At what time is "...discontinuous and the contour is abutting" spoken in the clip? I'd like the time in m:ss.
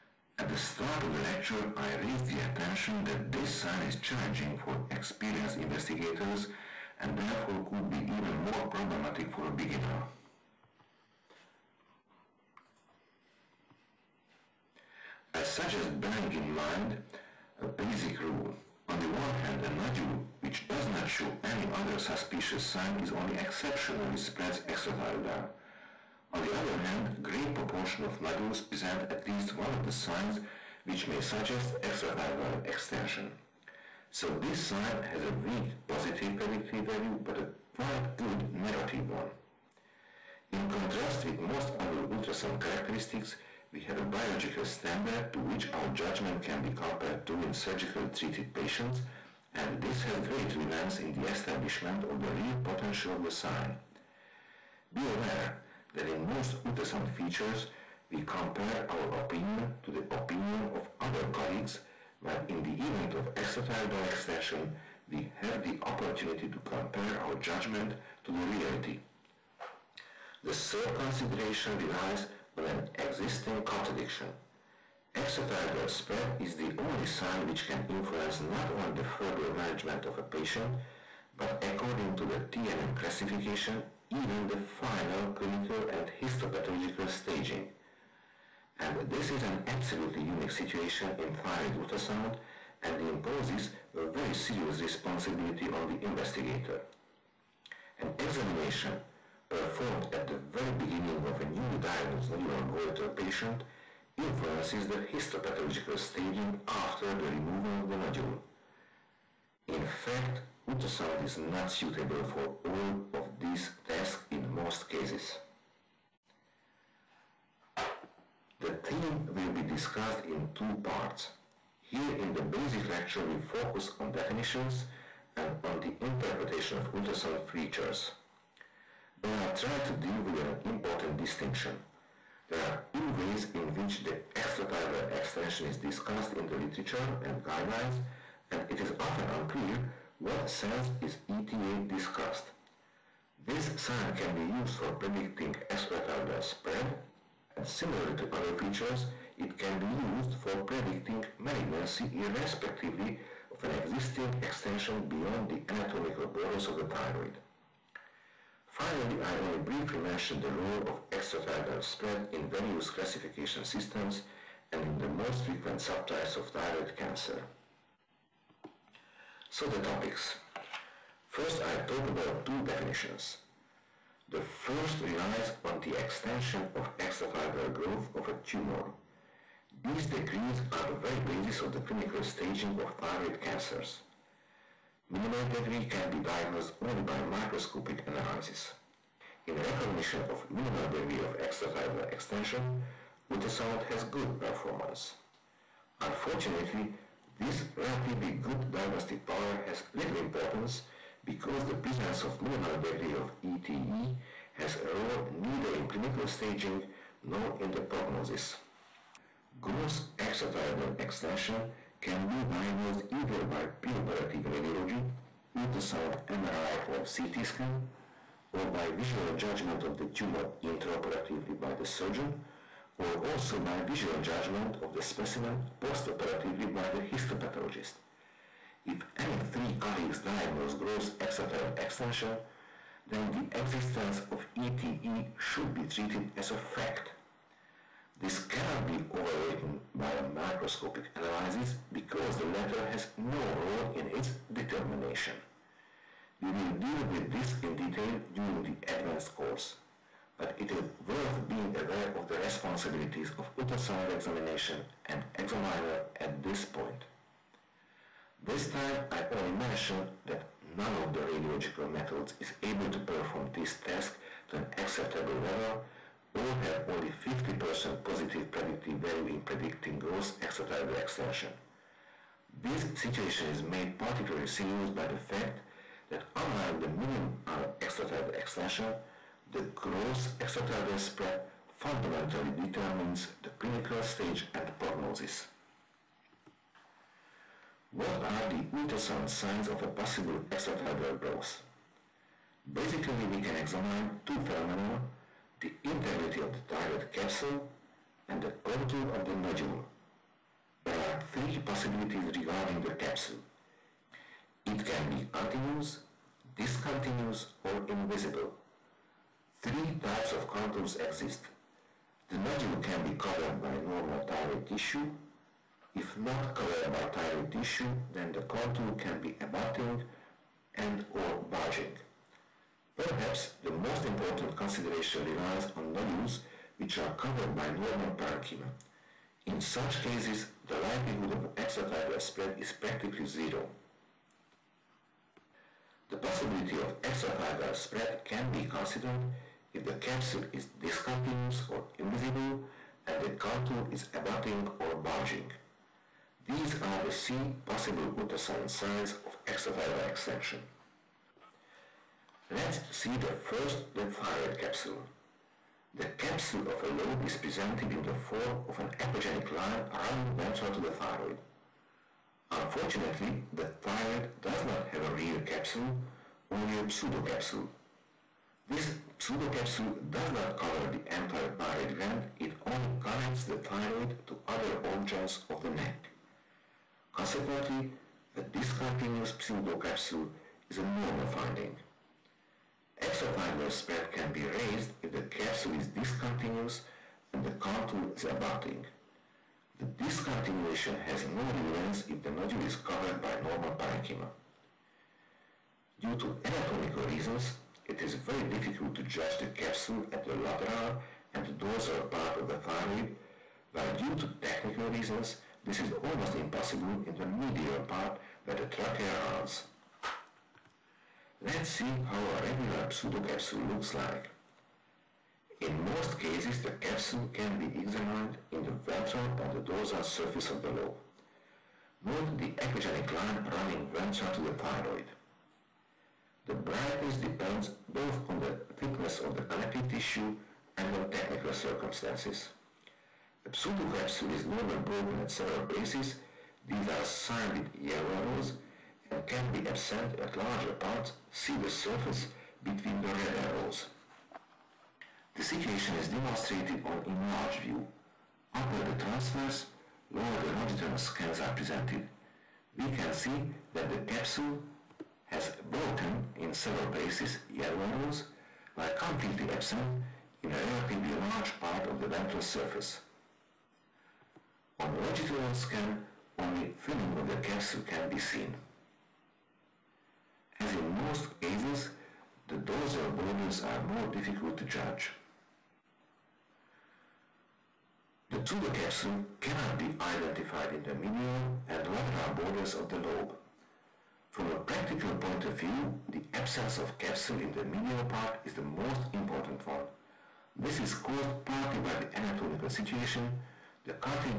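6:25.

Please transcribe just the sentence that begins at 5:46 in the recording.
These are the C possible ultrasound signs of extrathyroidal extension.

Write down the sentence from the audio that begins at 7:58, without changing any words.
The pseudocapsule cannot be identified in the medial and lateral borders of the lobe.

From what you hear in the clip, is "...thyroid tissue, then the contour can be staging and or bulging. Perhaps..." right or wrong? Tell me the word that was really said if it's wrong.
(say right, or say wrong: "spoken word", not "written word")
wrong: "abutting", not "staging".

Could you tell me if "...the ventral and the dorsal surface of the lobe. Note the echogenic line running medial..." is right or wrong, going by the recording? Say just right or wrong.
wrong.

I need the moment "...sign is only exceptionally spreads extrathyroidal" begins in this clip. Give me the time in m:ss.
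0:22.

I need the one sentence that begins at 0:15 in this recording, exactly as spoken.
I suggest bearing in mind a basic rule.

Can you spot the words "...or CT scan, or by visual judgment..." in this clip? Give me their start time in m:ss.
3:36.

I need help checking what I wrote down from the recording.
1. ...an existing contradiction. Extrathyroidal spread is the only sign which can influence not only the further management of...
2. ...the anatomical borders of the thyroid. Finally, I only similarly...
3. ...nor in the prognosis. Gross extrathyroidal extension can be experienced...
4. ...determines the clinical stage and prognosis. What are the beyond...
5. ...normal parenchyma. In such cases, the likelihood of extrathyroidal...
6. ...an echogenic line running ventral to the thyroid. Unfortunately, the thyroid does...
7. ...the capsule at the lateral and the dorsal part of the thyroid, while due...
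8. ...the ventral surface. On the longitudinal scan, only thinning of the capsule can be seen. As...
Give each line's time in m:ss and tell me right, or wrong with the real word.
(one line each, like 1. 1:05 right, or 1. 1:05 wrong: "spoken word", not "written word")
1. 1:12 right
2. 2:35 wrong: "briefly", not "similarly"
3. 3:27 wrong: "diagnosed", not "experienced"
4. 4:42 wrong: "ultrasound", not "beyond"
5. 5:27 right
6. 5:58 right
7. 6:39 right
8. 7:41 right.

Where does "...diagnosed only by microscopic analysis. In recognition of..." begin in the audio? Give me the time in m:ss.
3:06.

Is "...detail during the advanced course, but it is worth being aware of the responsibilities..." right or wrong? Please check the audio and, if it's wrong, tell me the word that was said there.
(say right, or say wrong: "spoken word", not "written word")
right.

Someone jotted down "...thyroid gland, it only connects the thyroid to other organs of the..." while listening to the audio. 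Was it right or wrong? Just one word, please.
right.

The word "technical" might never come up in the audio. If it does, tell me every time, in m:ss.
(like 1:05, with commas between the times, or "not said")
6:44, 7:11.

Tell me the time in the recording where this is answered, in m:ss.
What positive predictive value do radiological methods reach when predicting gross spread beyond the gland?
4:27.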